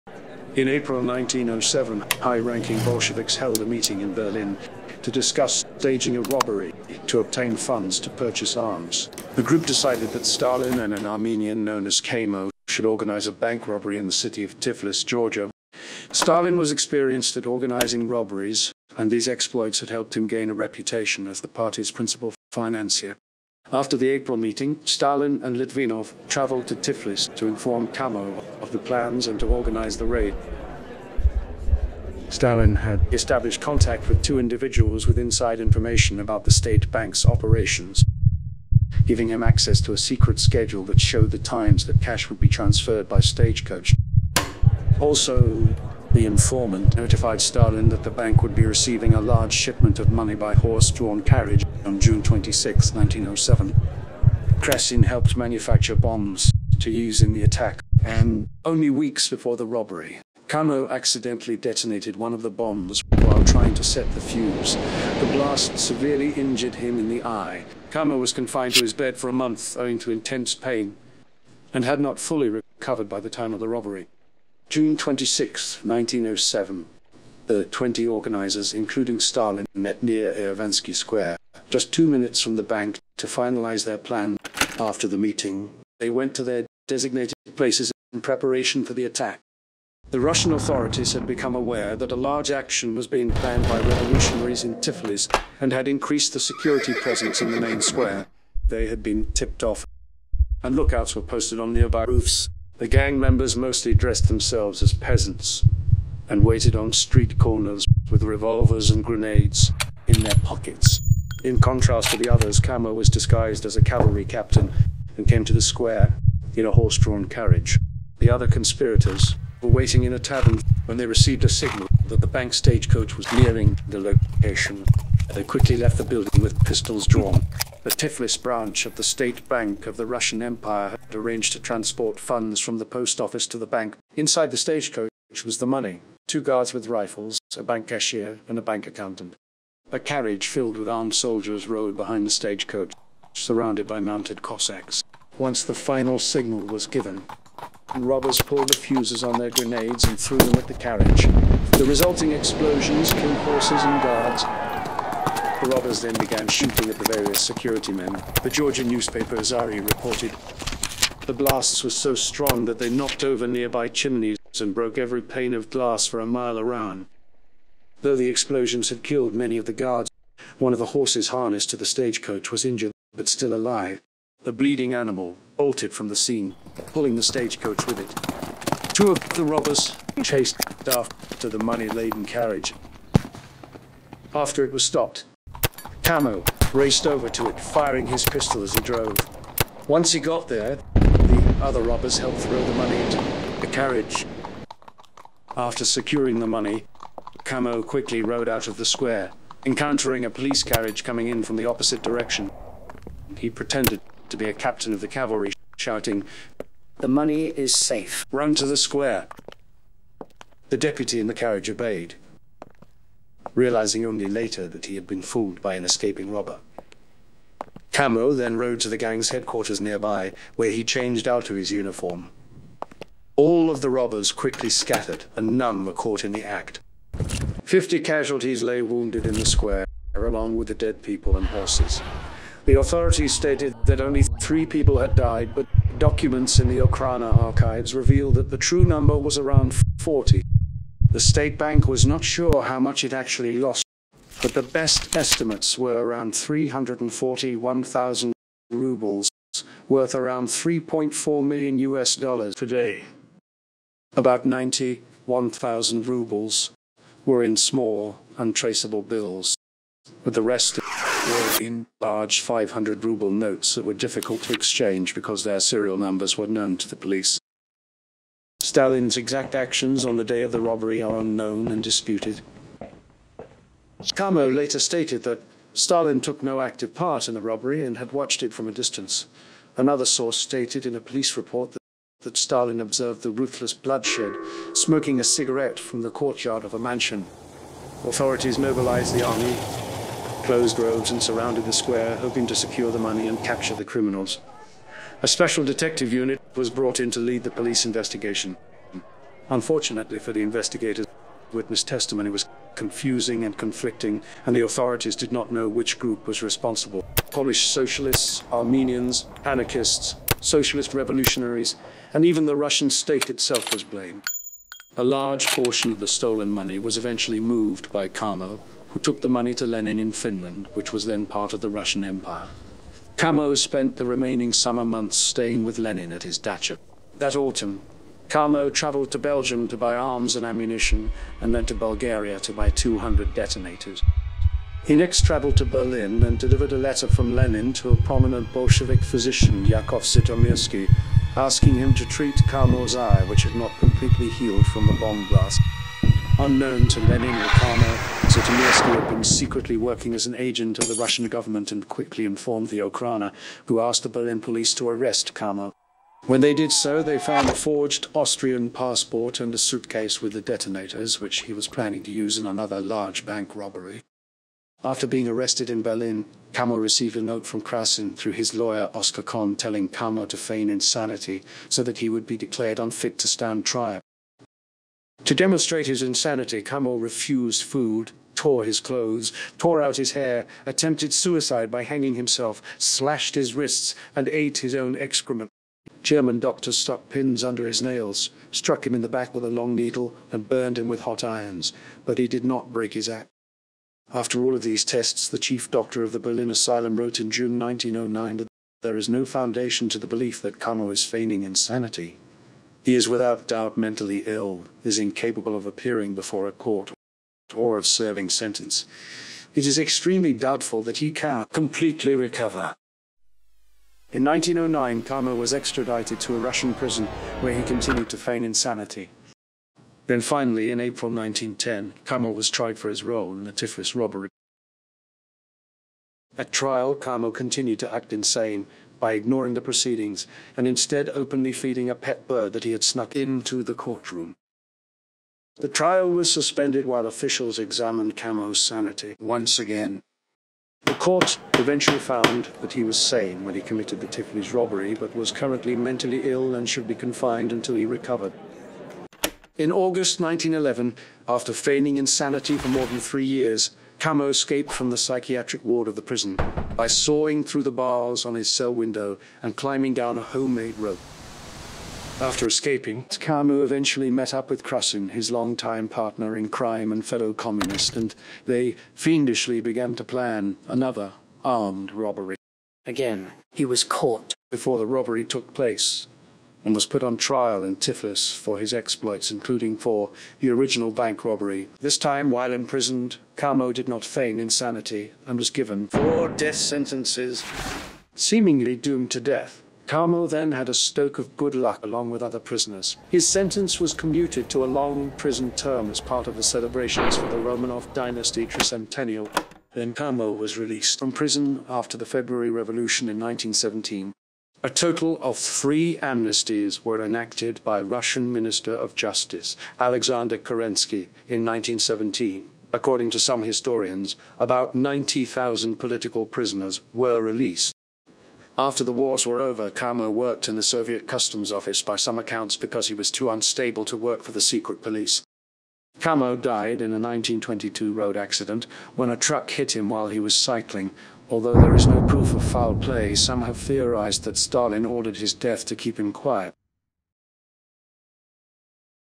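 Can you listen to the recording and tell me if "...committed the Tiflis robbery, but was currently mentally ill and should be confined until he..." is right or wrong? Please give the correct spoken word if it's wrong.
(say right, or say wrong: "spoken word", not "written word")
right.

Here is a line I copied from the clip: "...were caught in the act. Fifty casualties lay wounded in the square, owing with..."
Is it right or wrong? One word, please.
wrong.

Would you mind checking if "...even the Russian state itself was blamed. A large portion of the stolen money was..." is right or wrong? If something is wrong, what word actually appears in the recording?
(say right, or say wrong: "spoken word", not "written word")
right.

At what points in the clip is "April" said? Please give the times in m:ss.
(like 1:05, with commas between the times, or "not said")
0:00, 0:24, 7:00.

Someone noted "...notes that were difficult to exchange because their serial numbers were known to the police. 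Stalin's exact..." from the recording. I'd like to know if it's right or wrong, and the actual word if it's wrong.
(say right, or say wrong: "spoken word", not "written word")
right.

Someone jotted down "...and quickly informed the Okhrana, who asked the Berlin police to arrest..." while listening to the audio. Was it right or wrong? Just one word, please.
right.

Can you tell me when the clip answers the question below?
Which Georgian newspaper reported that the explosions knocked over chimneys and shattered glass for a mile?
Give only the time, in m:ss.
2:39.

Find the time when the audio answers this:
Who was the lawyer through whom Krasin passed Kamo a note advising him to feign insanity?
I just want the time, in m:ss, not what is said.
6:08.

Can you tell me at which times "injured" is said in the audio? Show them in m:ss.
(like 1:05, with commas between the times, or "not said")
1:06, 2:52.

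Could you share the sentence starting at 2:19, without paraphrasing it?
A carriage filled with armed soldiers rode behind the stagecoach, surrounded by mounted Cossacks.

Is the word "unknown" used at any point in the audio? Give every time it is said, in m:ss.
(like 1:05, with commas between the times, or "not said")
4:31, 5:46.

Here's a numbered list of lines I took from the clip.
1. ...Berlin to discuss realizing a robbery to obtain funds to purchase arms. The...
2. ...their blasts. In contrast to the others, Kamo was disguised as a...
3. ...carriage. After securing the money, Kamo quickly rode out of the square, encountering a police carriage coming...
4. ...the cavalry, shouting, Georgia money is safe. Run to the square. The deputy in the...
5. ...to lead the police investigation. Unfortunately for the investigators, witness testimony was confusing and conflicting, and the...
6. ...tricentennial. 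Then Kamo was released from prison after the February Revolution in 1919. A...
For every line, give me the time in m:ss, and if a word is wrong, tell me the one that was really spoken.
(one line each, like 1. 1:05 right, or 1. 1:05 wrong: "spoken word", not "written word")
1. 0:04 wrong: "staging", not "realizing"
2. 1:50 wrong: "pockets", not "blasts"
3. 3:13 right
4. 3:24 wrong: "The", not "Georgia"
5. 4:57 right
6. 8:18 wrong: "1917", not "1919".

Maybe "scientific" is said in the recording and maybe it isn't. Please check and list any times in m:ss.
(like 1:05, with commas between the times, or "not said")
not said.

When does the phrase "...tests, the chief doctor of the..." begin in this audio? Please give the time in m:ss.
6:34.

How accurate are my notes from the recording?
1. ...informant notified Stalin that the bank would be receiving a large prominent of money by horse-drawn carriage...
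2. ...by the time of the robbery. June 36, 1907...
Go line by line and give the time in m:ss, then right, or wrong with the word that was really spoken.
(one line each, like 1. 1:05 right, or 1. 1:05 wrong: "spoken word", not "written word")
1. 0:46 wrong: "shipment", not "prominent"
2. 1:13 wrong: "26", not "36".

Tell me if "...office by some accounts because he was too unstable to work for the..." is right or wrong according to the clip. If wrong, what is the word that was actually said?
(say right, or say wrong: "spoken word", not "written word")
right.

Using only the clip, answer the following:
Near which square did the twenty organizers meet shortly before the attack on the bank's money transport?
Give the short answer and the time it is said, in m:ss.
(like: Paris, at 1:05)
Erivansky Square, at 1:20.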